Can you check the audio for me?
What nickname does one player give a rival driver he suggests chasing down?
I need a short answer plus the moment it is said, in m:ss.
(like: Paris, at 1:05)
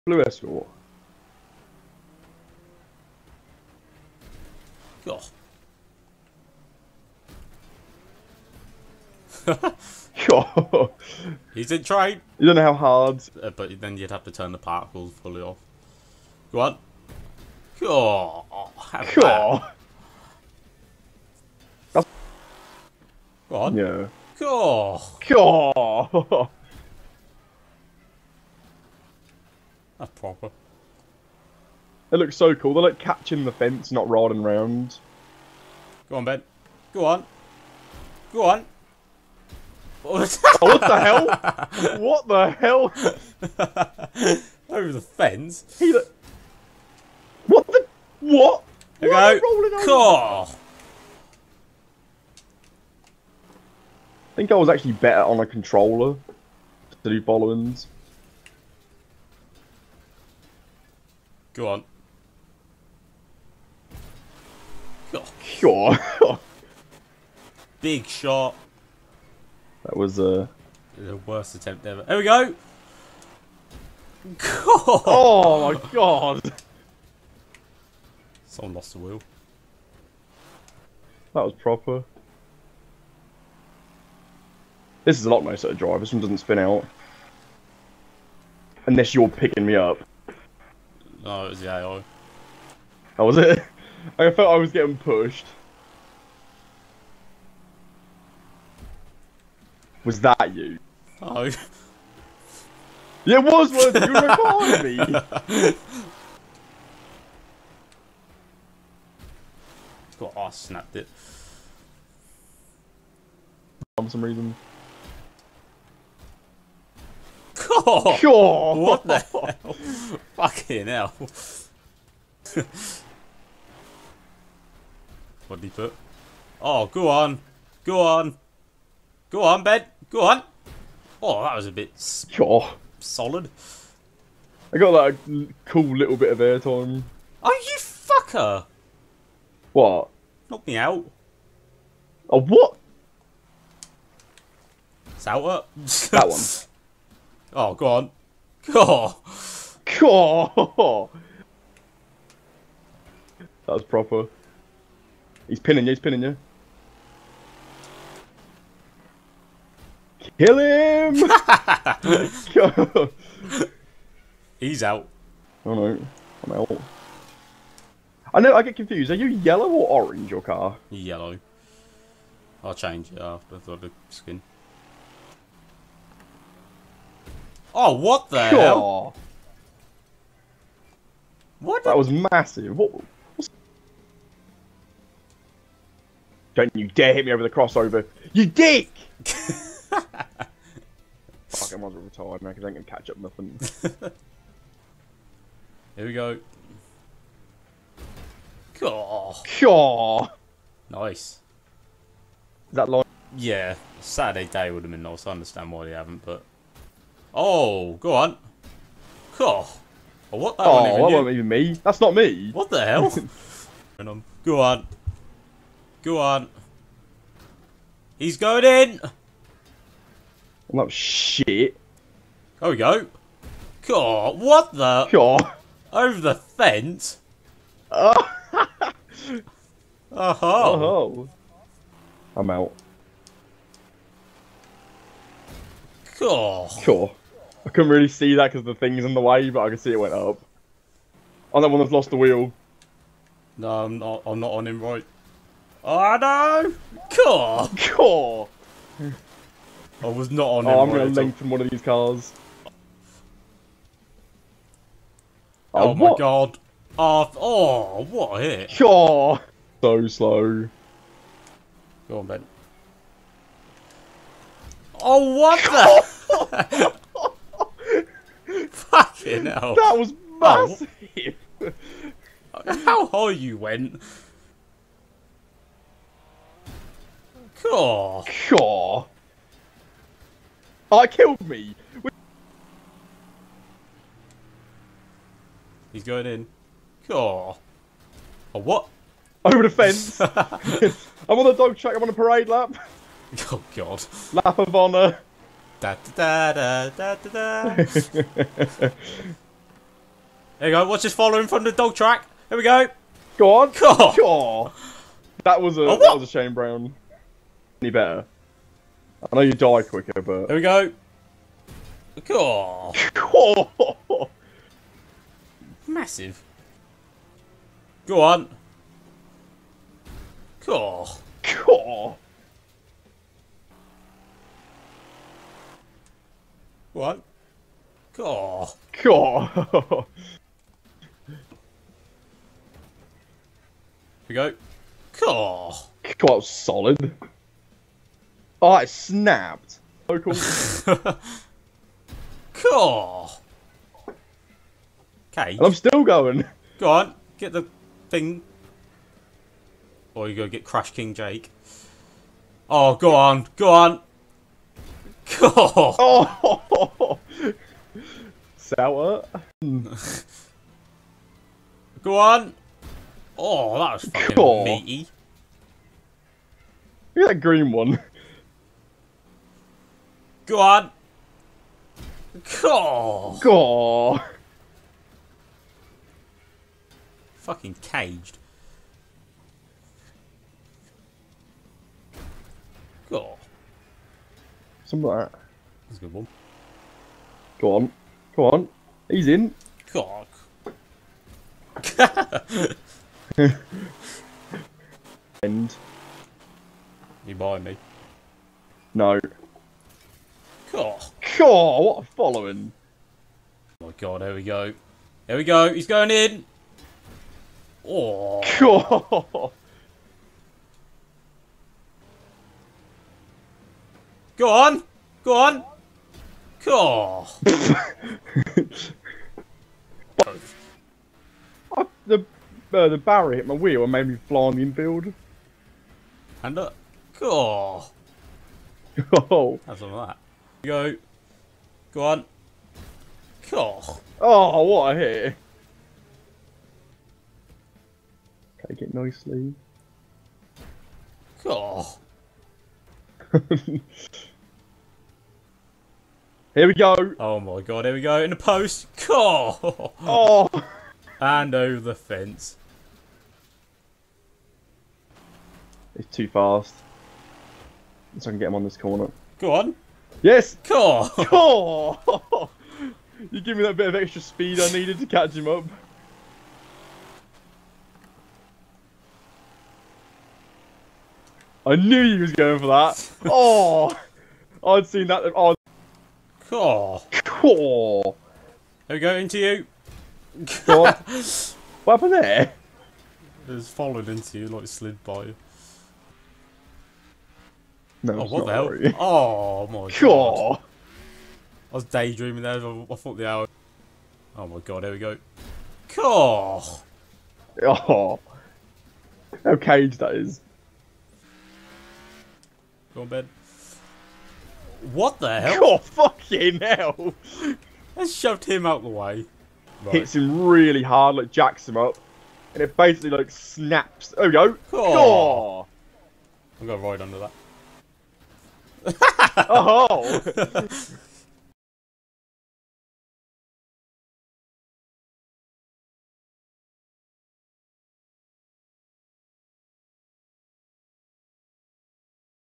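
Crash King Jake, at 5:50.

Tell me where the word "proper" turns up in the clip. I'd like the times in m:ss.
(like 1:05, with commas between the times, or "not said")
0:30, 1:21, 2:33.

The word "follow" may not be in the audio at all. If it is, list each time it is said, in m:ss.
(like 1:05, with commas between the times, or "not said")
0:57, 5:01, 6:42.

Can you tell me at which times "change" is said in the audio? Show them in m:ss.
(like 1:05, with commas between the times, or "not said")
2:52.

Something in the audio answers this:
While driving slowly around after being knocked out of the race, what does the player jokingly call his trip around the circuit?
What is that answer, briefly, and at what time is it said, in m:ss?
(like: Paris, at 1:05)
Lap of honour, at 4:54.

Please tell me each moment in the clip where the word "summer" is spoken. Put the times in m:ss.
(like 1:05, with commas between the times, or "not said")
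not said.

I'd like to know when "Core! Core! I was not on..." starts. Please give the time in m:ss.
4:07.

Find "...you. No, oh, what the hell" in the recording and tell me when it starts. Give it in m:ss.
8:05.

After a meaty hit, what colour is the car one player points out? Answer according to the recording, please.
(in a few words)
Green.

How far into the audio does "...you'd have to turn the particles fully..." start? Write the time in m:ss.
0:13.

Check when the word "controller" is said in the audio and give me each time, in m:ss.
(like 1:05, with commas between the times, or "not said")
0:55.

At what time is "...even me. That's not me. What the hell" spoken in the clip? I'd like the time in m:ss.
3:31.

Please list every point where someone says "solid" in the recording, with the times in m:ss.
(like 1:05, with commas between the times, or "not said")
2:12, 5:36.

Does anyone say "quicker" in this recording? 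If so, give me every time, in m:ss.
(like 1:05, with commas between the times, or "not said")
5:09.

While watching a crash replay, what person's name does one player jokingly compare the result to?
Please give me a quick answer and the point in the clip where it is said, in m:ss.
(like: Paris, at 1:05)
Shane Brown, at 5:06.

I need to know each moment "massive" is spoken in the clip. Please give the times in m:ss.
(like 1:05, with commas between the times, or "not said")
3:02, 4:30, 5:15.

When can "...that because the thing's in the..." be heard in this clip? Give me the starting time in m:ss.
3:58.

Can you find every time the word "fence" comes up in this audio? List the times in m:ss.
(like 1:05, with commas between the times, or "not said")
0:33, 0:45, 3:46, 4:49, 7:31.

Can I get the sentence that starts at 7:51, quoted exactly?
I knew he was going for that.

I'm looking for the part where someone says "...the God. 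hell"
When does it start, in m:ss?
2:58.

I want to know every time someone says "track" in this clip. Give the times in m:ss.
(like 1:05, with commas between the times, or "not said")
4:51, 5:01.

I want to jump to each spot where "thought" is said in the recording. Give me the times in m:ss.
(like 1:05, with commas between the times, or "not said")
8:12.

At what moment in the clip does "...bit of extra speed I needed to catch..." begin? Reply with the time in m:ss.
7:43.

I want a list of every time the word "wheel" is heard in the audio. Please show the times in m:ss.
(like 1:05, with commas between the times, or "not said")
1:18, 4:02, 7:03.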